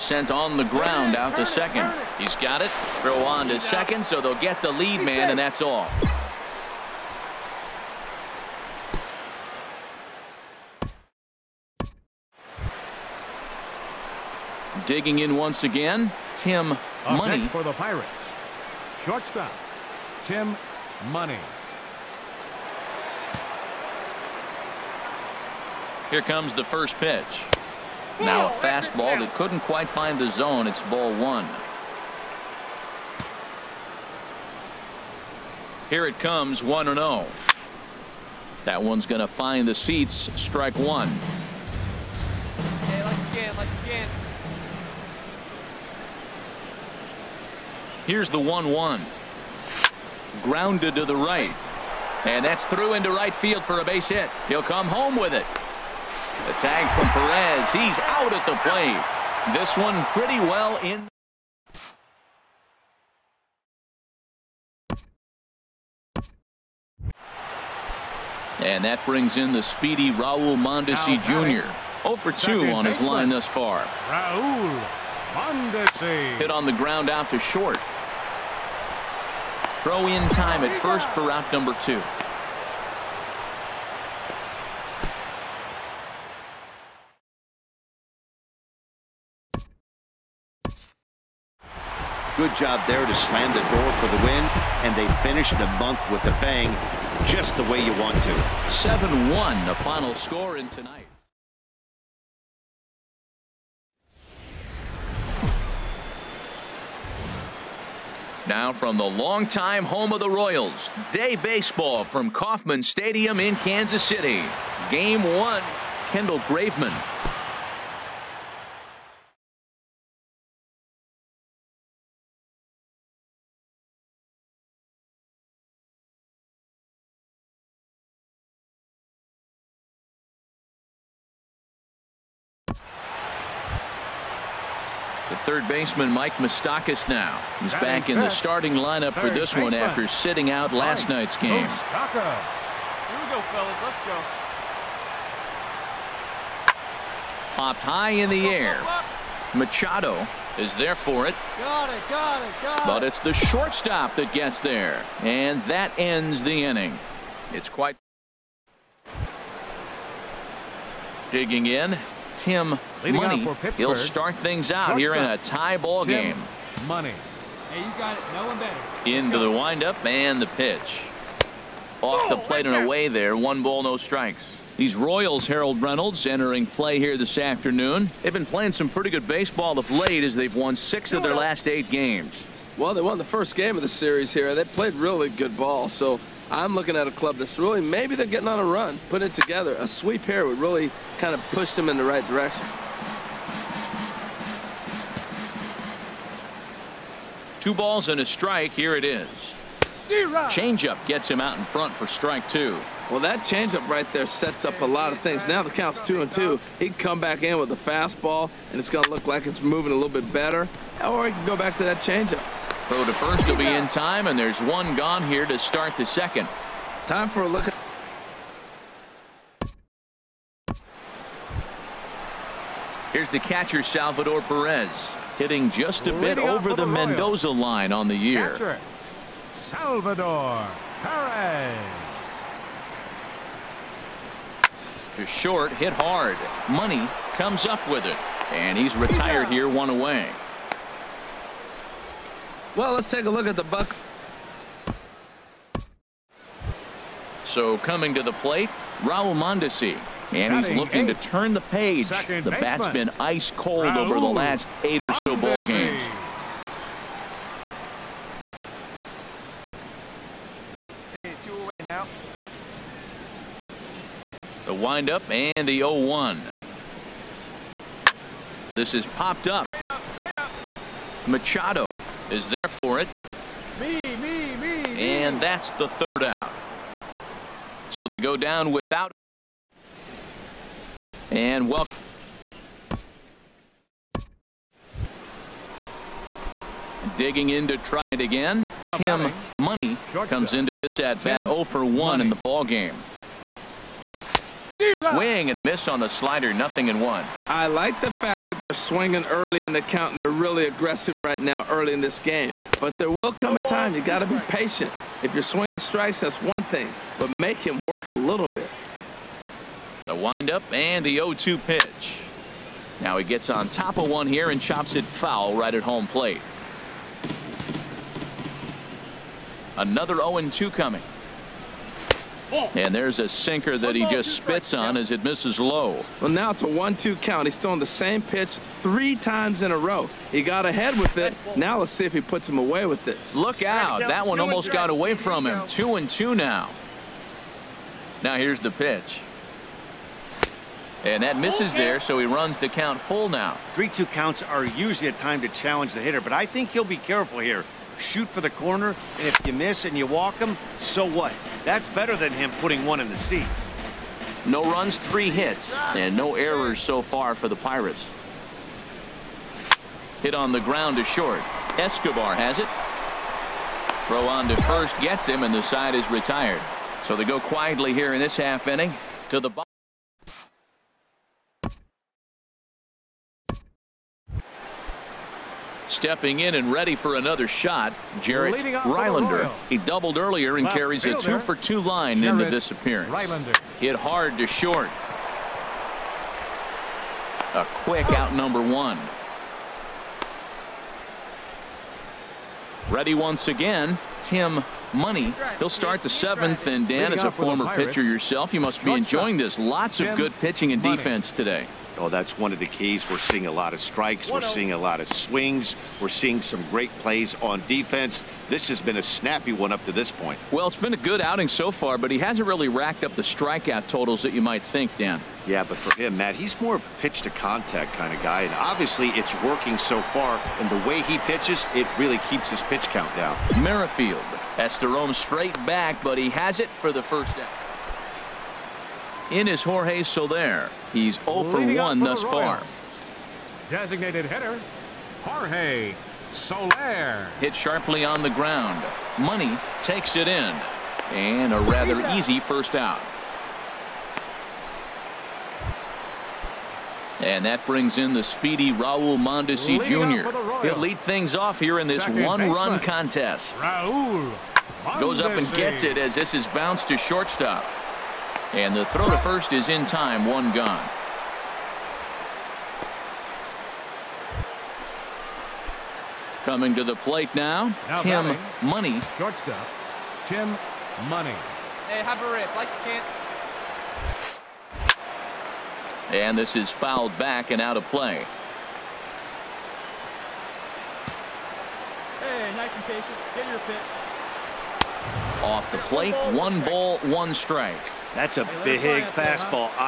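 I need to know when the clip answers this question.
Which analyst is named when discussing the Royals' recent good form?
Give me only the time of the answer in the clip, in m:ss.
2:55.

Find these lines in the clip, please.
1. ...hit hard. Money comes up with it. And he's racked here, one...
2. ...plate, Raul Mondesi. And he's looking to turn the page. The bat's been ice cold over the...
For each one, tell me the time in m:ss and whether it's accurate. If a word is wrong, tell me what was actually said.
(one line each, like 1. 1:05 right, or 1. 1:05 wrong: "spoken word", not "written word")
1. 3:55 wrong: "retired", not "racked"
2. 4:08 right.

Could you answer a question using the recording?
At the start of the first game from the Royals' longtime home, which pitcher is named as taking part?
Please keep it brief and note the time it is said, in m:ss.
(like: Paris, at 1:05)
Kendall Graveman, at 1:56.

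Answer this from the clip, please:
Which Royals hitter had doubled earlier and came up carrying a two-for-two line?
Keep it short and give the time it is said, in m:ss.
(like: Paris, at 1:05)
Jarrett Rylander, at 6:18.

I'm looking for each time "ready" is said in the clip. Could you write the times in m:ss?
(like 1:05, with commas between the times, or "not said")
6:16, 6:32.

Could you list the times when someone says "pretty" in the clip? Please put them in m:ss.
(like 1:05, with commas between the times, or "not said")
1:00, 2:58.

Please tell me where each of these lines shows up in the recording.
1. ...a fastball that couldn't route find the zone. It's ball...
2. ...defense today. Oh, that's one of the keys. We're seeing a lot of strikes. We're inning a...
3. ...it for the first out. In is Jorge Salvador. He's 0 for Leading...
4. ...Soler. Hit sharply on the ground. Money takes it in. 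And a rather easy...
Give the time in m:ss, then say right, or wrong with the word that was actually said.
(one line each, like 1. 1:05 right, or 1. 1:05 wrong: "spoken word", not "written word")
1. 0:28 wrong: "quite", not "route"
2. 6:40 wrong: "seeing", not "inning"
3. 7:06 wrong: "Soler", not "Salvador"
4. 7:16 right.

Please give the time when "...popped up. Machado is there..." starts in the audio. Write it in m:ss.
4:29.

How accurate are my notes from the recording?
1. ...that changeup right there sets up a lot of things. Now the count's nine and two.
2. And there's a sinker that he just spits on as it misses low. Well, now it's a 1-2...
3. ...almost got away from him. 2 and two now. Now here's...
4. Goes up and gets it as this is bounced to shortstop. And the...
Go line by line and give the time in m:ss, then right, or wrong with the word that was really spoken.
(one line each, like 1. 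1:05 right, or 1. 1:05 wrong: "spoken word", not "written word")
1. 3:23 wrong: "two", not "nine"
2. 5:22 right
3. 5:34 right
4. 7:34 right.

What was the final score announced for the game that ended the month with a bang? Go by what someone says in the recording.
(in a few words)
7-1.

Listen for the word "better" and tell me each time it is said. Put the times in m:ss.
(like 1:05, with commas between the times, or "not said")
2:48, 3:30, 5:51.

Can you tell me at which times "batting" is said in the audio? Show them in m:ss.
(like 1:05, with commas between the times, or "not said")
4:49, 7:48.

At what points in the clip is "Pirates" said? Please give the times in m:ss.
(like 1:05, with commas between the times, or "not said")
0:17, 5:57.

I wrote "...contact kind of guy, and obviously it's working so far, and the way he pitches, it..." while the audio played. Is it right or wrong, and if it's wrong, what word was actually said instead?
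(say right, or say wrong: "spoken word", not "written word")
right.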